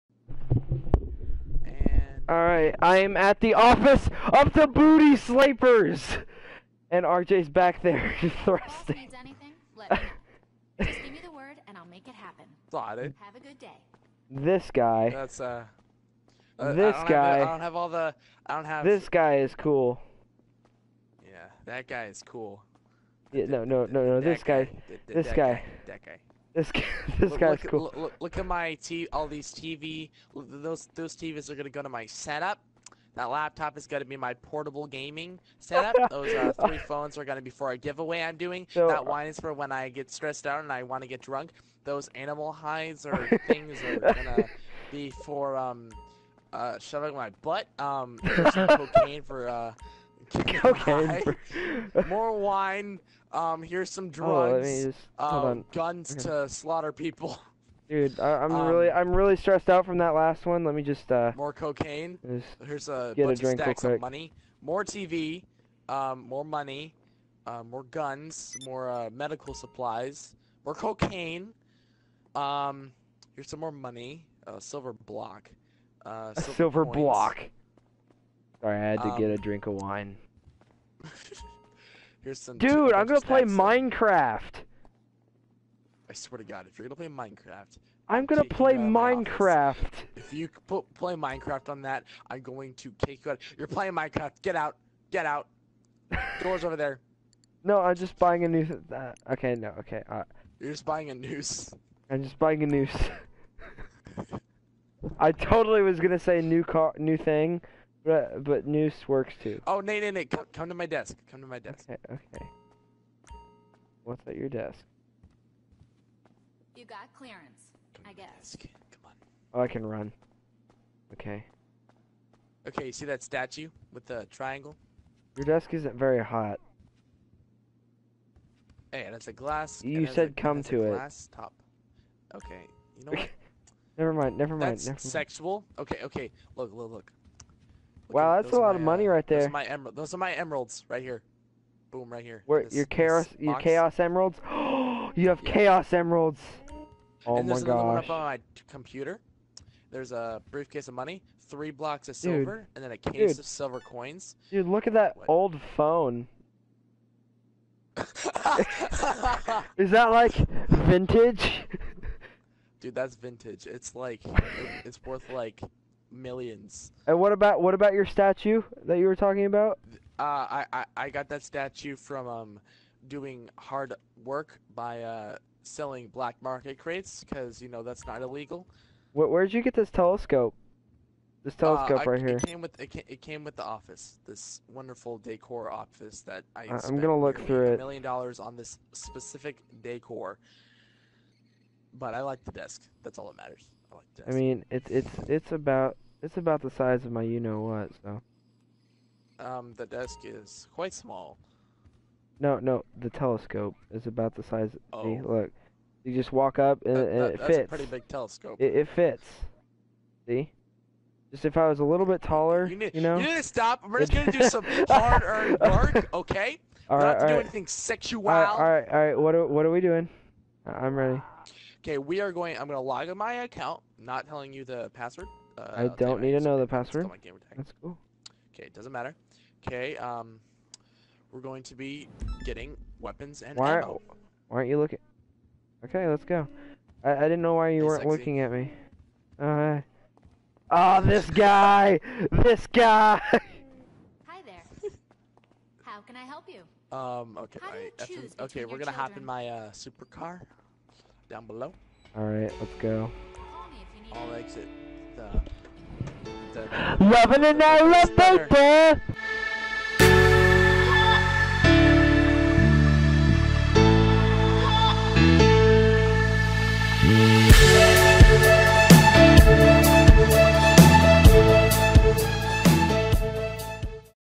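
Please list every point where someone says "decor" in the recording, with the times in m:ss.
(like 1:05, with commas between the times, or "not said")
3:05, 3:09.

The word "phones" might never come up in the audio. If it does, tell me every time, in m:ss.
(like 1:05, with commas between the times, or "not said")
0:36, 2:35.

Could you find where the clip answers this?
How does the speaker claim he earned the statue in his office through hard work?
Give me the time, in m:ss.
2:56.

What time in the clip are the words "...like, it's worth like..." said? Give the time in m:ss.
2:43.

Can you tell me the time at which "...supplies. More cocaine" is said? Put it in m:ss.
1:09.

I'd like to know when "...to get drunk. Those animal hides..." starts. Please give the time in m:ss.
0:41.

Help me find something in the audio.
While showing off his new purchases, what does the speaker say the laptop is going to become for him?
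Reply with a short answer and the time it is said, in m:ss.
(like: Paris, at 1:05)
portable gaming setup, at 0:34.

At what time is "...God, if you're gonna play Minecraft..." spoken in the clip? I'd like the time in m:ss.
1:26.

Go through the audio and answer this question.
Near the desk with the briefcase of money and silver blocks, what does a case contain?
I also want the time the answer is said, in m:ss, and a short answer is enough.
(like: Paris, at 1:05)
silver coins, at 2:33.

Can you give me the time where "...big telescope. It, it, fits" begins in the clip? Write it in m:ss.
3:27.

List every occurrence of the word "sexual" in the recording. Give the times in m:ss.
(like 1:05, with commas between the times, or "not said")
2:15, 3:37.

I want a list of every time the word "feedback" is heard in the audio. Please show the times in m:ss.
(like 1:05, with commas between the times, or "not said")
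not said.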